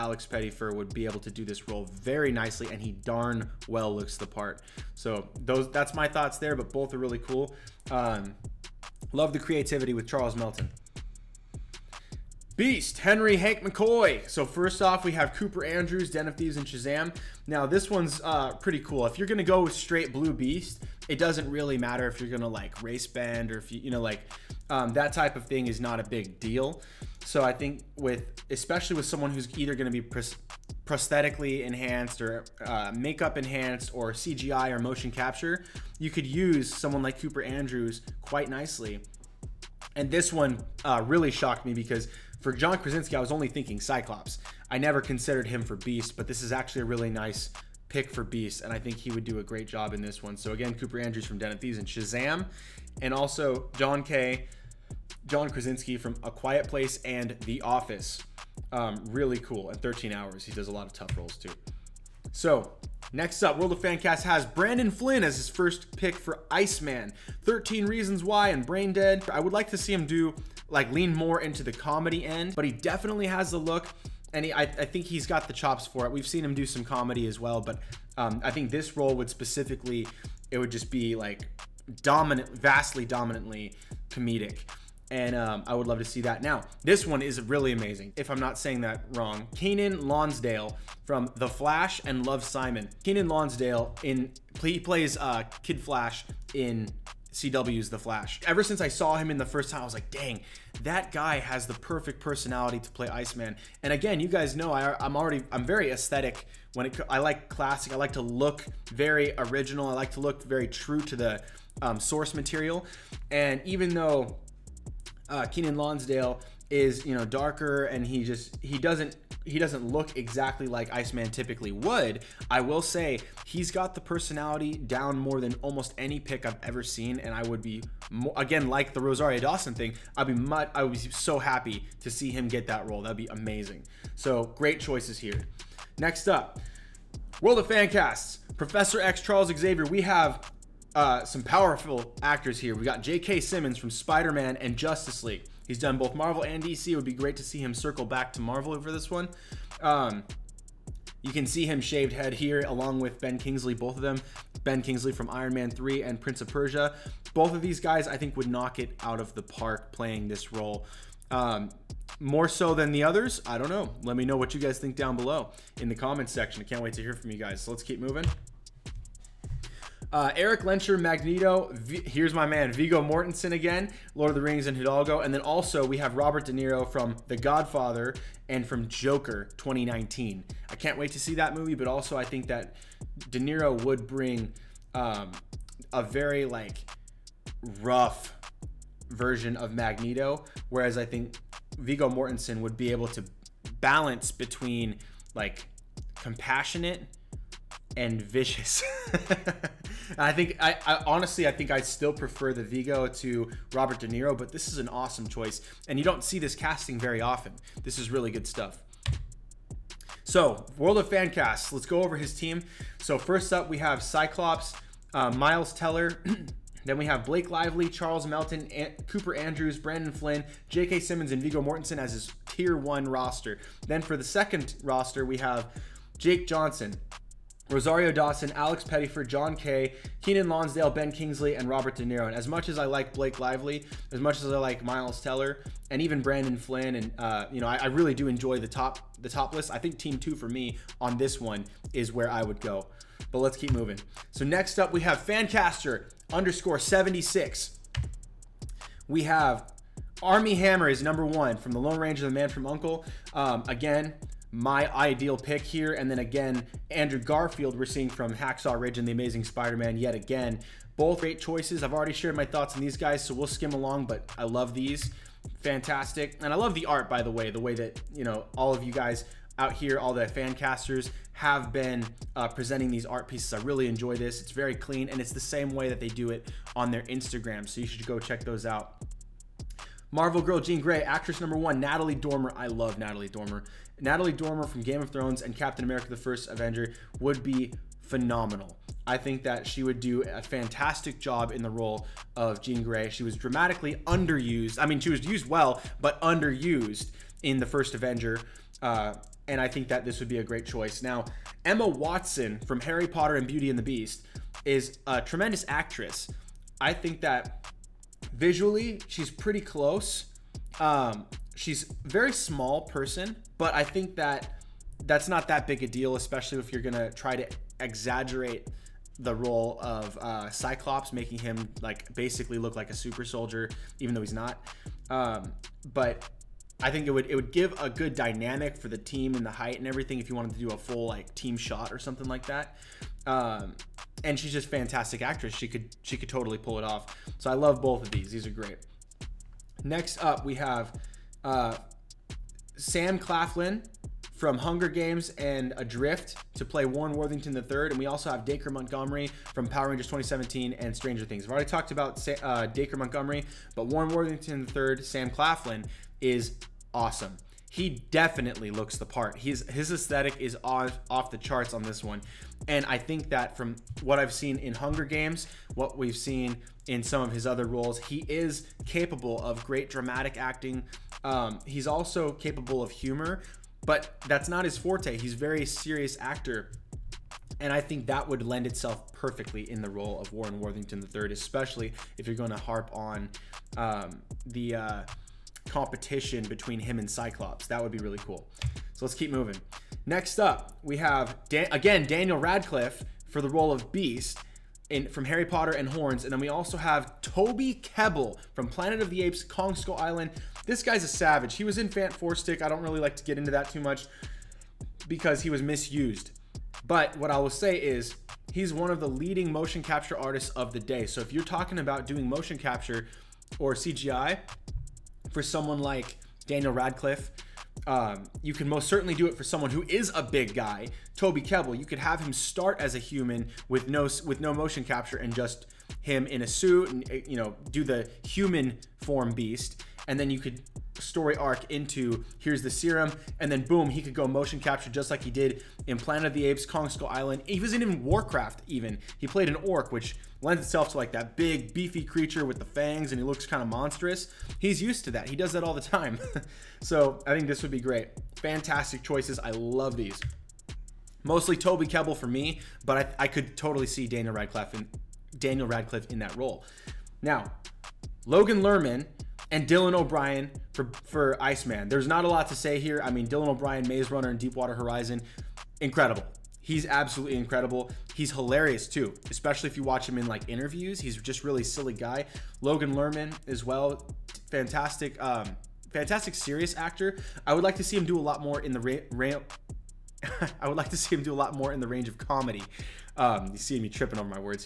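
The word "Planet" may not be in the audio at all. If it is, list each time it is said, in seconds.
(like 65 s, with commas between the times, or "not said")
398 s, 435 s.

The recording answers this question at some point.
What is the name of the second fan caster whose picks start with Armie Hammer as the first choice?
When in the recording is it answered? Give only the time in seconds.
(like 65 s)
245 s.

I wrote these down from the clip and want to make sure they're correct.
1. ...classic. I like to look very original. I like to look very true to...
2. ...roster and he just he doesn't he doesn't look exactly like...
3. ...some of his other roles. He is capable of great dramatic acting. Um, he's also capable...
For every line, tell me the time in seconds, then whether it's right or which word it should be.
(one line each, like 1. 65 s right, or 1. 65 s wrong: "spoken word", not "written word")
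1. 107 s right
2. 117 s wrong: "darker", not "roster"
3. 367 s right.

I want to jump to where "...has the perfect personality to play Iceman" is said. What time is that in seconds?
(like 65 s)
101 s.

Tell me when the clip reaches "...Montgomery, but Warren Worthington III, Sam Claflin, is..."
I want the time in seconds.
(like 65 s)
352 s.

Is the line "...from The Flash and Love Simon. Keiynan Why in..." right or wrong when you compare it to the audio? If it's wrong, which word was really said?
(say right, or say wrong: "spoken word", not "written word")
wrong: "Lonsdale", not "Why".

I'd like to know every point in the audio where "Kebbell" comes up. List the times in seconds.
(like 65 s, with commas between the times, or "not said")
397 s, 421 s, 451 s.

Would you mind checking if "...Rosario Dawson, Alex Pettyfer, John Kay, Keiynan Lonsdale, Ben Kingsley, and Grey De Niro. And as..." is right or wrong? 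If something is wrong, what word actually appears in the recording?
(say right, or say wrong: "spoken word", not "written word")
wrong: "Robert", not "Grey".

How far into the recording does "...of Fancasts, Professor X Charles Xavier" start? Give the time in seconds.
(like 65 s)
137 s.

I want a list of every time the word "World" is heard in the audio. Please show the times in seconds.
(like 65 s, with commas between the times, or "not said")
63 s, 137 s, 210 s.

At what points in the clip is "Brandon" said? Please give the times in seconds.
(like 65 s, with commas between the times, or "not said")
64 s, 219 s, 236 s.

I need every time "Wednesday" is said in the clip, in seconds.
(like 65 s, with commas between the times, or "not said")
not said.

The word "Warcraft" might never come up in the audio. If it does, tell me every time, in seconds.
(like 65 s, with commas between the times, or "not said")
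438 s.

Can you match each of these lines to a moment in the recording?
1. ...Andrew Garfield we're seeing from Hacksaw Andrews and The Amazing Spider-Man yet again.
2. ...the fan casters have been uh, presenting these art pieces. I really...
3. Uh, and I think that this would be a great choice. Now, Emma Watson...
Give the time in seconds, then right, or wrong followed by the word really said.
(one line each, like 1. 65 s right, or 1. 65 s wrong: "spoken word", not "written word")
1. 256 s wrong: "Ridge", not "Andrews"
2. 270 s right
3. 298 s right.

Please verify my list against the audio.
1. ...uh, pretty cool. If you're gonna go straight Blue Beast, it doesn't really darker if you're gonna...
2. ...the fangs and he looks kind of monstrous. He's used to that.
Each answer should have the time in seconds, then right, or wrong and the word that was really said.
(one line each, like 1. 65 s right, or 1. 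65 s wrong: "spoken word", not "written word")
1. 18 s wrong: "matter", not "darker"
2. 442 s right.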